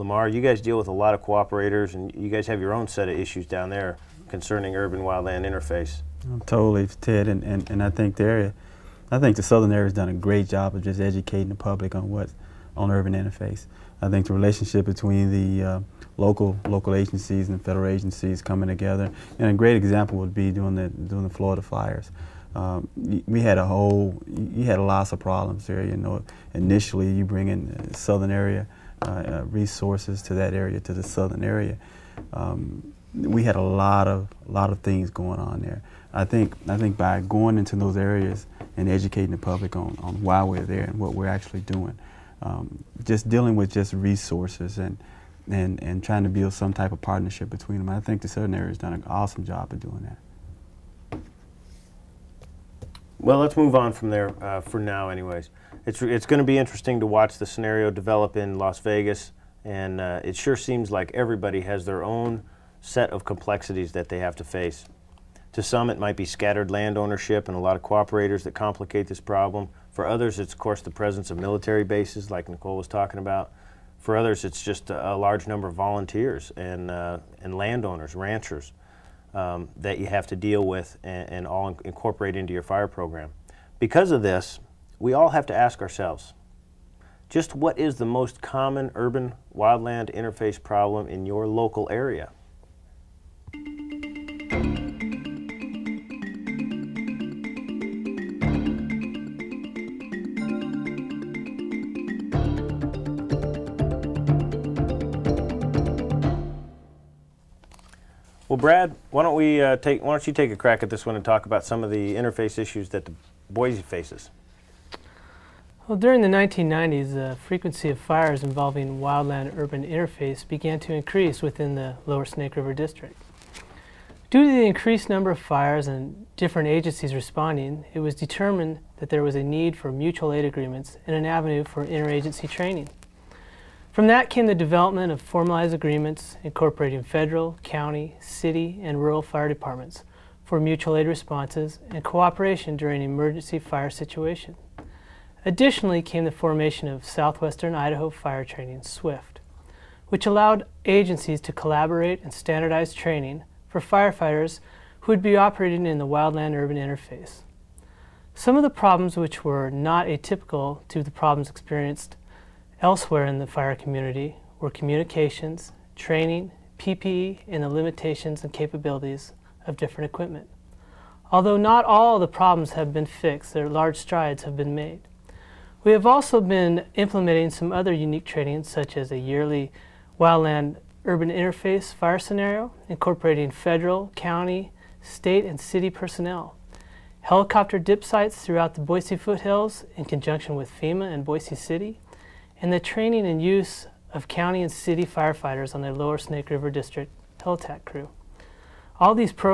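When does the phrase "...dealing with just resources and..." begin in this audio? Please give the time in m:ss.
0:43.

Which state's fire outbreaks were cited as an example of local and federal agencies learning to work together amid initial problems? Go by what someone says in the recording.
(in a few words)
Florida.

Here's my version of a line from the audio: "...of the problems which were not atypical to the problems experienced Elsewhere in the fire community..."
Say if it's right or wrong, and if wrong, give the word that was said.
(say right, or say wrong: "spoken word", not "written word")
right.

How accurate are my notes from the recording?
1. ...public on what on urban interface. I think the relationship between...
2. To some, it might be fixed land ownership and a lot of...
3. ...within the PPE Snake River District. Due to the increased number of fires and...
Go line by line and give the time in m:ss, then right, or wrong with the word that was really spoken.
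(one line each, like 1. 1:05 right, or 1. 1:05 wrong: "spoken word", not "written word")
1. 0:11 right
2. 1:05 wrong: "scattered", not "fixed"
3. 2:01 wrong: "Lower", not "PPE".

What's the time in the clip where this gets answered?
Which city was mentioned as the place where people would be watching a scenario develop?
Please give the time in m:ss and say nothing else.
0:58.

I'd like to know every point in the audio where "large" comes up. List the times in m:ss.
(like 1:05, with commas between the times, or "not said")
1:15, 2:53.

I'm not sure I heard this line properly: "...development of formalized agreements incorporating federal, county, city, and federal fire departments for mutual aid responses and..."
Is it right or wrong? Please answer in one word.
wrong.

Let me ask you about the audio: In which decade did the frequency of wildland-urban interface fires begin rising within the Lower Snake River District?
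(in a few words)
1990s.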